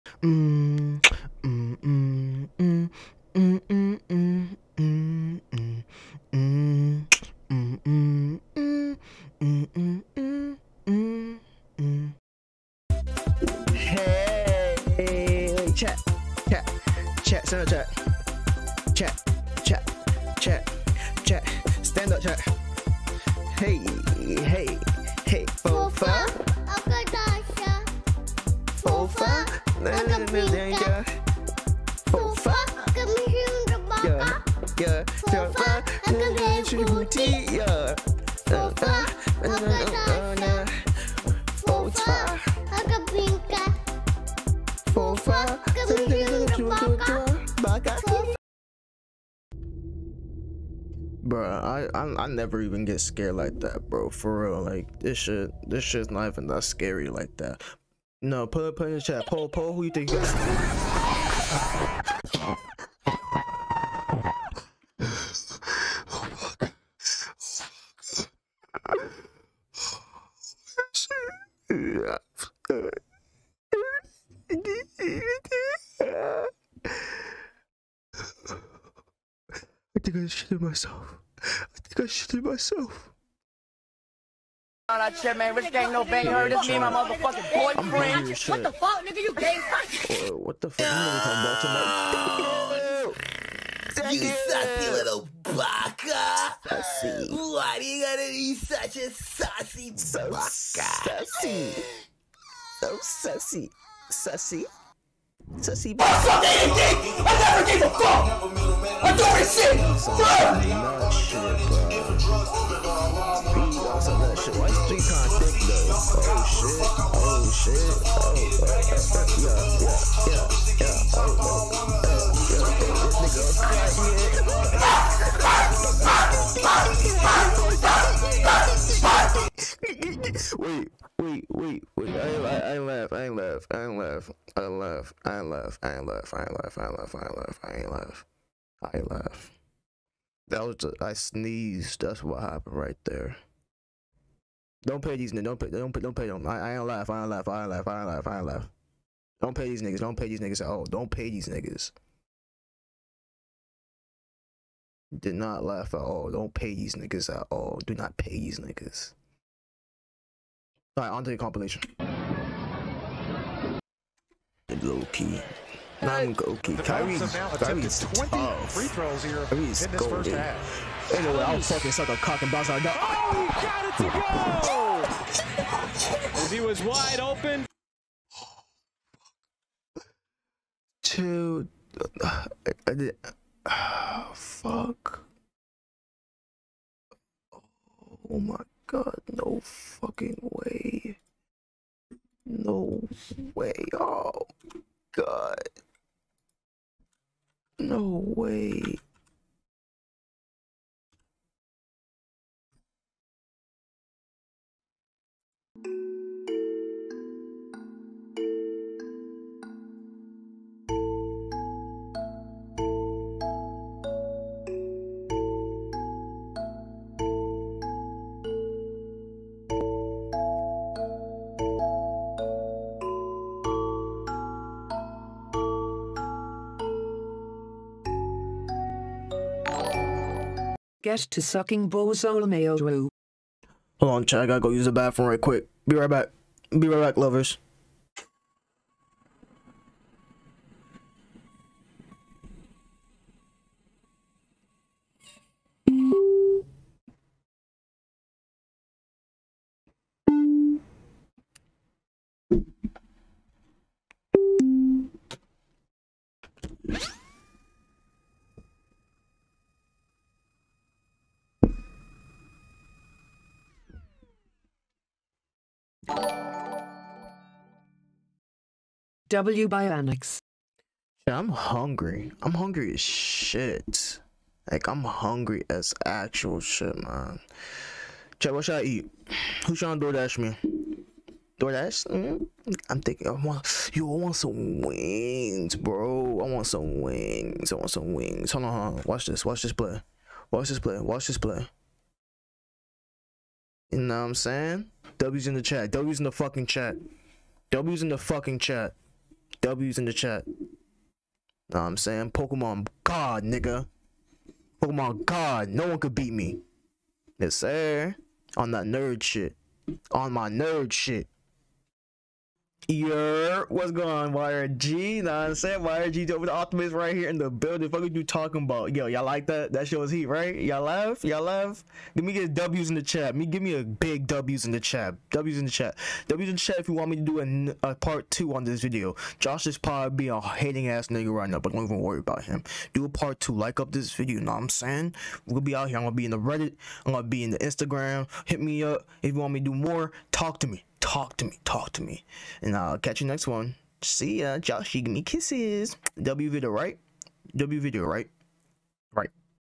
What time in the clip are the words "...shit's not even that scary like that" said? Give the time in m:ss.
0:55.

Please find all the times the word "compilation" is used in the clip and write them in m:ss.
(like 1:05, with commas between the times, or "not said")
2:41.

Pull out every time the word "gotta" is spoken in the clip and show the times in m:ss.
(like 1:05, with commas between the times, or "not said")
1:38, 3:54.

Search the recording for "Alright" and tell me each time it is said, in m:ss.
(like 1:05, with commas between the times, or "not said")
2:40.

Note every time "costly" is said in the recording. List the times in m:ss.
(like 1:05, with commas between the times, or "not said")
not said.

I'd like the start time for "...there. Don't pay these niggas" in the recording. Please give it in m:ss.
2:23.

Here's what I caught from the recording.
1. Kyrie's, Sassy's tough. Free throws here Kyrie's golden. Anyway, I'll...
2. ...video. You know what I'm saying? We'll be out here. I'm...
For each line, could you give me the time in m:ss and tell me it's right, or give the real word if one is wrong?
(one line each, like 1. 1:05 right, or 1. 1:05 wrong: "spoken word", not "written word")
1. 2:46 wrong: "Kyrie", not "Sassy"
2. 5:34 right.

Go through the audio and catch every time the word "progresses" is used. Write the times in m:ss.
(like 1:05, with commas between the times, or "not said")
not said.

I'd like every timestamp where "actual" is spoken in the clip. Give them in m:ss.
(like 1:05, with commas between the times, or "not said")
4:36.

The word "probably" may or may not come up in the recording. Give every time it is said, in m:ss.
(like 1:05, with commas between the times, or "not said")
5:29.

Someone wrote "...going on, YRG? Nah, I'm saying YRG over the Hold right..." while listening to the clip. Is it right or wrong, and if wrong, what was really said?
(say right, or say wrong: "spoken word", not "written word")
wrong: "Optimist", not "Hold".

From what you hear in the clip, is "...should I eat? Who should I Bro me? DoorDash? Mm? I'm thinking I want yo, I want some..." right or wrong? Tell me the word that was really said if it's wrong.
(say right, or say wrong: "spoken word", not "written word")
wrong: "DoorDash", not "Bro".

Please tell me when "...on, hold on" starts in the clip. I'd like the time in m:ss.
4:48.